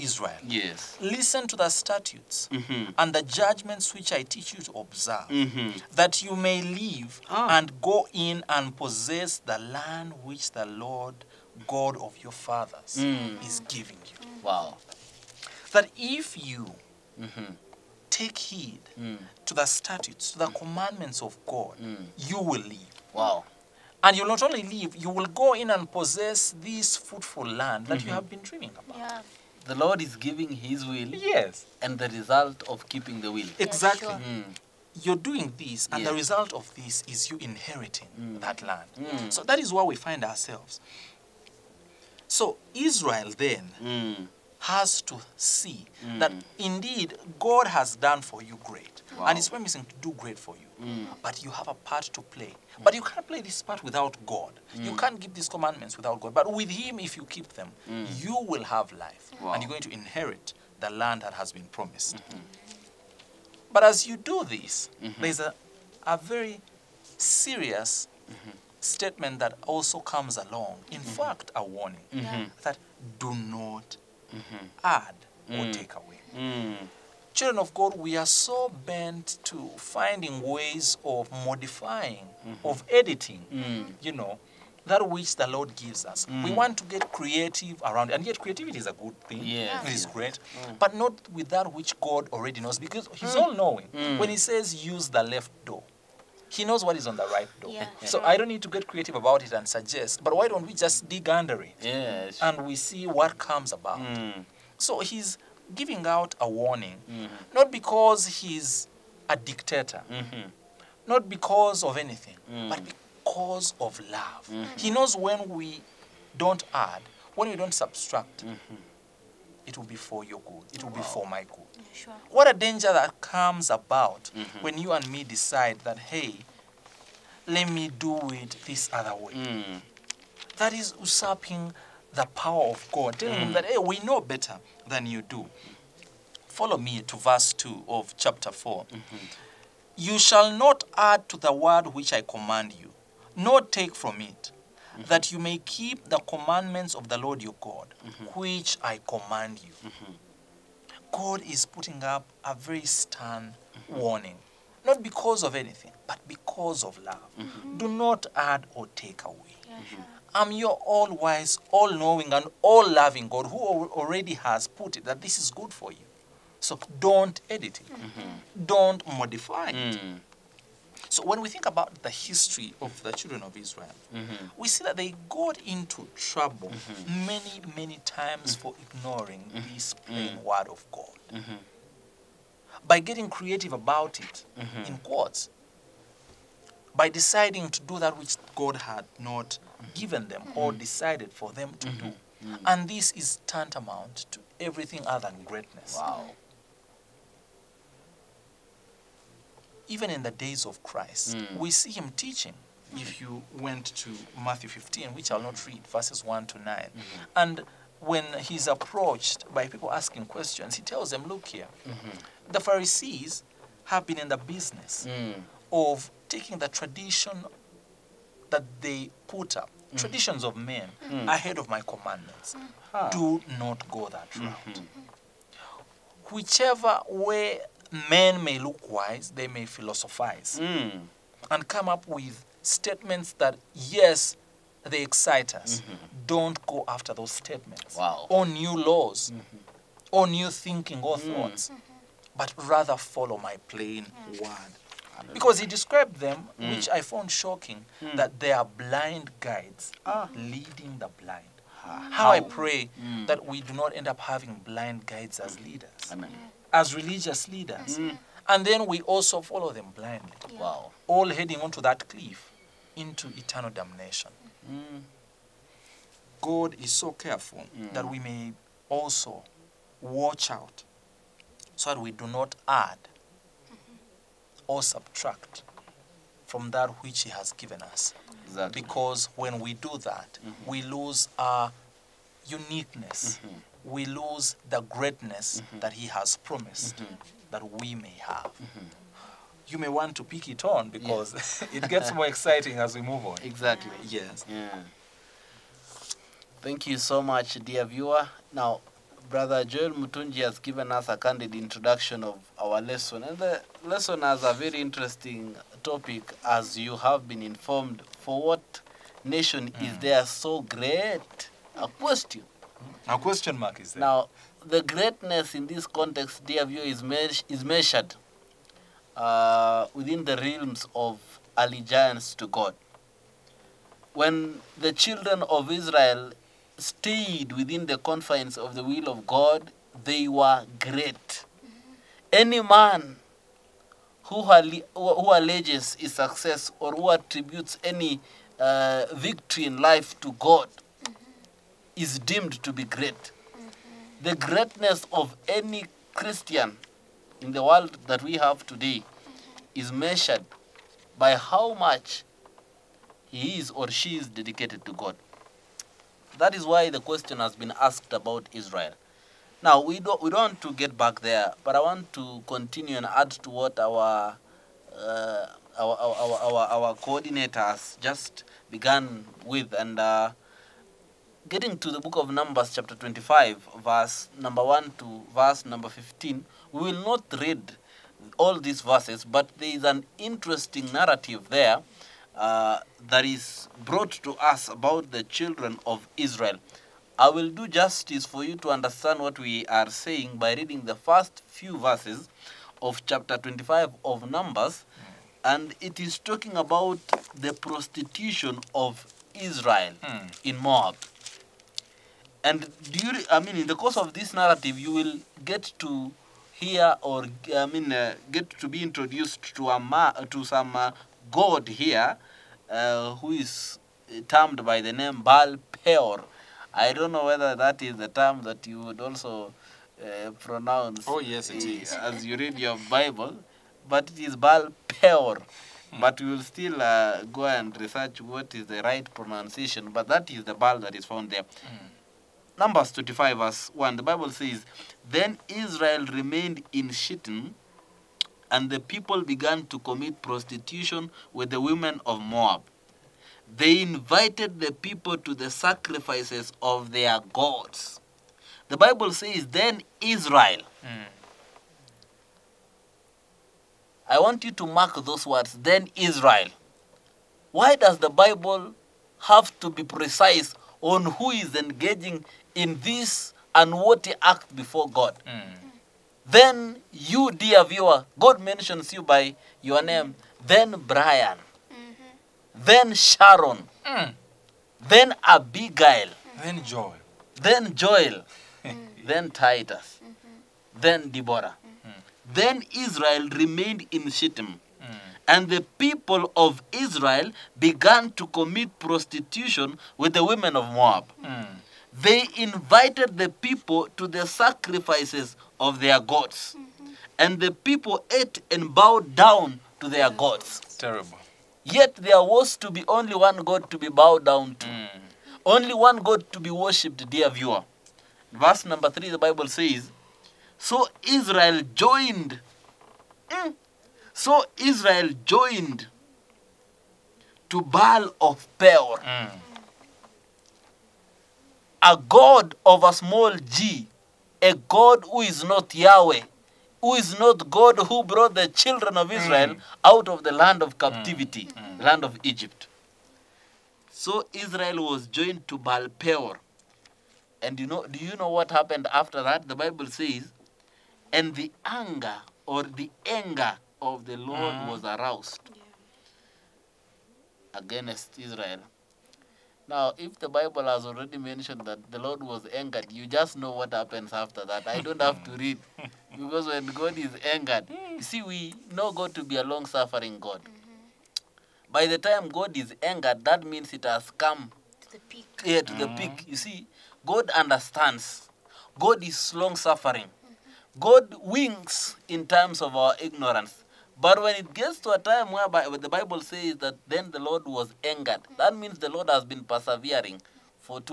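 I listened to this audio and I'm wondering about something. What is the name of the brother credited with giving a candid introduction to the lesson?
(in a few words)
Joel Mutunji.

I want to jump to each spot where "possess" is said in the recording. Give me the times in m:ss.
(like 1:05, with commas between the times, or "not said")
0:08, 0:25.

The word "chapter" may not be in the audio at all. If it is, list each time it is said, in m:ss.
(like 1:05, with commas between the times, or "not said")
2:18, 6:12, 6:33.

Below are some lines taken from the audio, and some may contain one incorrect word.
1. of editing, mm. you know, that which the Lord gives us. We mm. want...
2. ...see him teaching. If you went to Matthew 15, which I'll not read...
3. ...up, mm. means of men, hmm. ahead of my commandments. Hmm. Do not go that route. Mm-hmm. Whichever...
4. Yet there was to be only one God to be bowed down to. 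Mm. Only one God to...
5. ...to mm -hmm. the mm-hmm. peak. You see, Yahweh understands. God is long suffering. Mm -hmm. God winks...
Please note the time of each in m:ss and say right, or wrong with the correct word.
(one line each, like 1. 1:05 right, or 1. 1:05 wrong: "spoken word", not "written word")
1. 1:22 right
2. 3:21 right
3. 3:39 wrong: "traditions", not "means"
4. 8:21 right
5. 9:25 wrong: "God", not "Yahweh".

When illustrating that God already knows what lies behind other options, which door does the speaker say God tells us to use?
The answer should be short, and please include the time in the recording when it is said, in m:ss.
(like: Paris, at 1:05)
the left door, at 1:34.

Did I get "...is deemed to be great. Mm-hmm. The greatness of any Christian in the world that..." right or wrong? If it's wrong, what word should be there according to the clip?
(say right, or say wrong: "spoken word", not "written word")
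right.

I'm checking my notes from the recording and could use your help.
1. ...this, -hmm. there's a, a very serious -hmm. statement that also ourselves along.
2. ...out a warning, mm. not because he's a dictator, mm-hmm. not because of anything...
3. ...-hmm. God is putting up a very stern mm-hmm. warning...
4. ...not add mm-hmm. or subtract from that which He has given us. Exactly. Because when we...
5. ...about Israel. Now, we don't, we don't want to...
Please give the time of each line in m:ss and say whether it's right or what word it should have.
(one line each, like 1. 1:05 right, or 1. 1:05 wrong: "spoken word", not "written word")
1. 1:04 wrong: "comes", not "ourselves"
2. 1:46 right
3. 2:29 right
4. 4:32 right
5. 5:58 right.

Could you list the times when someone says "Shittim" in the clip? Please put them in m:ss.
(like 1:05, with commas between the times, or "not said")
7:16, 8:04.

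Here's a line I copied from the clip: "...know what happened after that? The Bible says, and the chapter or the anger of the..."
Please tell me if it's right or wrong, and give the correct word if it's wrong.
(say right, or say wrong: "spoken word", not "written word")
wrong: "anger", not "chapter".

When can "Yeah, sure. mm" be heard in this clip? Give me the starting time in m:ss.
0:34.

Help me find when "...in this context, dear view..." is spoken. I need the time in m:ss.
5:15.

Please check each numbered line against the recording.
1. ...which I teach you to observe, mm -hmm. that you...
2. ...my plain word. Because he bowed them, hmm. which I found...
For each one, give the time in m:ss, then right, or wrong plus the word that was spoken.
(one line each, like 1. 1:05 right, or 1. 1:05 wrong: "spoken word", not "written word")
1. 0:03 right
2. 4:03 wrong: "described", not "bowed".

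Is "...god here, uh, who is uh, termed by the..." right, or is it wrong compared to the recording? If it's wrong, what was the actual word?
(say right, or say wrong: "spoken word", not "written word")
right.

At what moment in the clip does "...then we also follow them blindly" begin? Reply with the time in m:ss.
4:18.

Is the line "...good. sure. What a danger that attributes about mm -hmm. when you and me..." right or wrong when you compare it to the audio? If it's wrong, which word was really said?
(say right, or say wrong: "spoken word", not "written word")
wrong: "comes", not "attributes".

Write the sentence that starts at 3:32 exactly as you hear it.
the Pharisees have been in the business mm.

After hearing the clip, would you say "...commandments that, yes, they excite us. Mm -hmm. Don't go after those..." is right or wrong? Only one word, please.
wrong.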